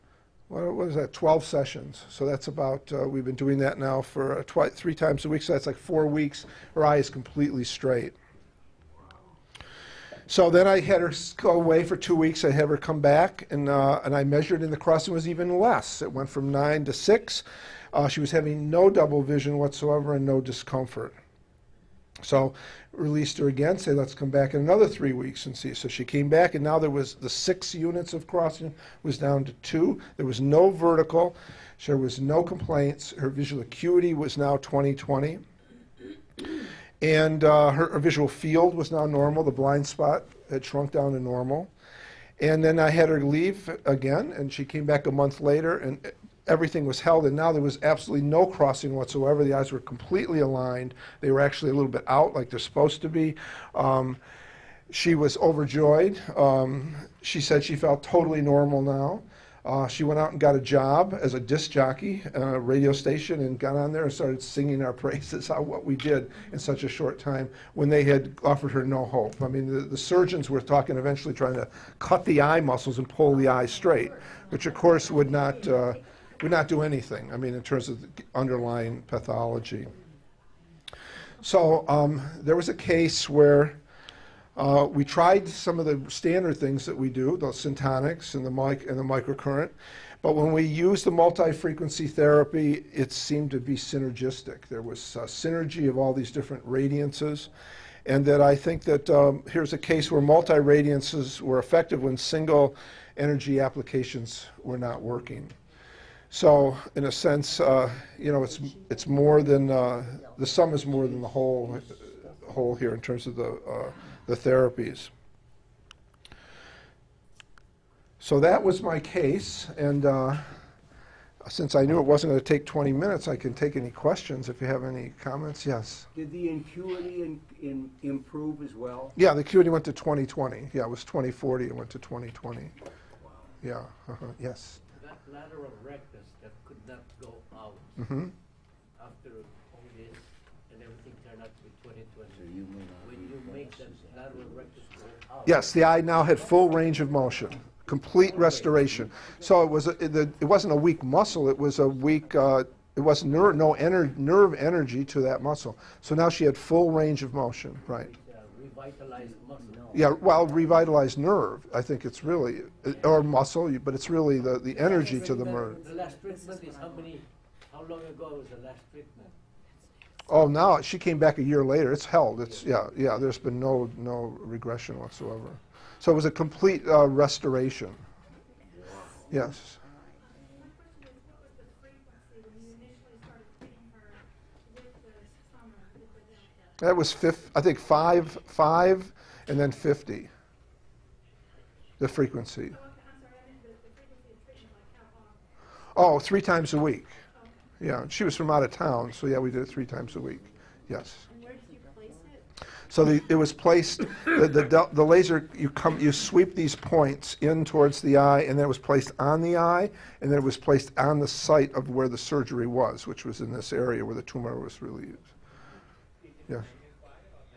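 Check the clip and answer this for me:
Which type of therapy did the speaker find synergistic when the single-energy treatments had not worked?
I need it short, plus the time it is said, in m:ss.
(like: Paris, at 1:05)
multi-frequency therapy, at 1:31.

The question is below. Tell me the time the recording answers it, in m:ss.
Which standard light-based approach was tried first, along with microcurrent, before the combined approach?
1:27.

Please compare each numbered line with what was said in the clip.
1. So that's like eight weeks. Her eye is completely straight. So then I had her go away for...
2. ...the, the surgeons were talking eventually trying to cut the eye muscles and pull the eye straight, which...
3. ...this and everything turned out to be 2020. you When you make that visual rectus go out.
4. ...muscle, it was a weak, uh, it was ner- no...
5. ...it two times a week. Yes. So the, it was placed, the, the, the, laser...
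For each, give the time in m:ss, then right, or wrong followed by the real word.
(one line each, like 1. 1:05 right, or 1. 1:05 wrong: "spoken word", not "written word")
1. 0:05 wrong: "four", not "eight"
2. 1:09 right
3. 2:19 wrong: "lateral", not "visual"
4. 2:31 right
5. 3:19 wrong: "three", not "two".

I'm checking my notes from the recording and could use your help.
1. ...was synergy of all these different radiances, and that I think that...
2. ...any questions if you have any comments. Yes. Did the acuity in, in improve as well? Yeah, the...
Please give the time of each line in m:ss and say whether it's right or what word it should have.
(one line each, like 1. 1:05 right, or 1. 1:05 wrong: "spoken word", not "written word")
1. 1:34 right
2. 2:03 right.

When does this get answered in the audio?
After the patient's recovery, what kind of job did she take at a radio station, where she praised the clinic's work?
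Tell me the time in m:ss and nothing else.
1:01.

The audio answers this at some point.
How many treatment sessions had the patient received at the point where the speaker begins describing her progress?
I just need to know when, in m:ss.
0:01.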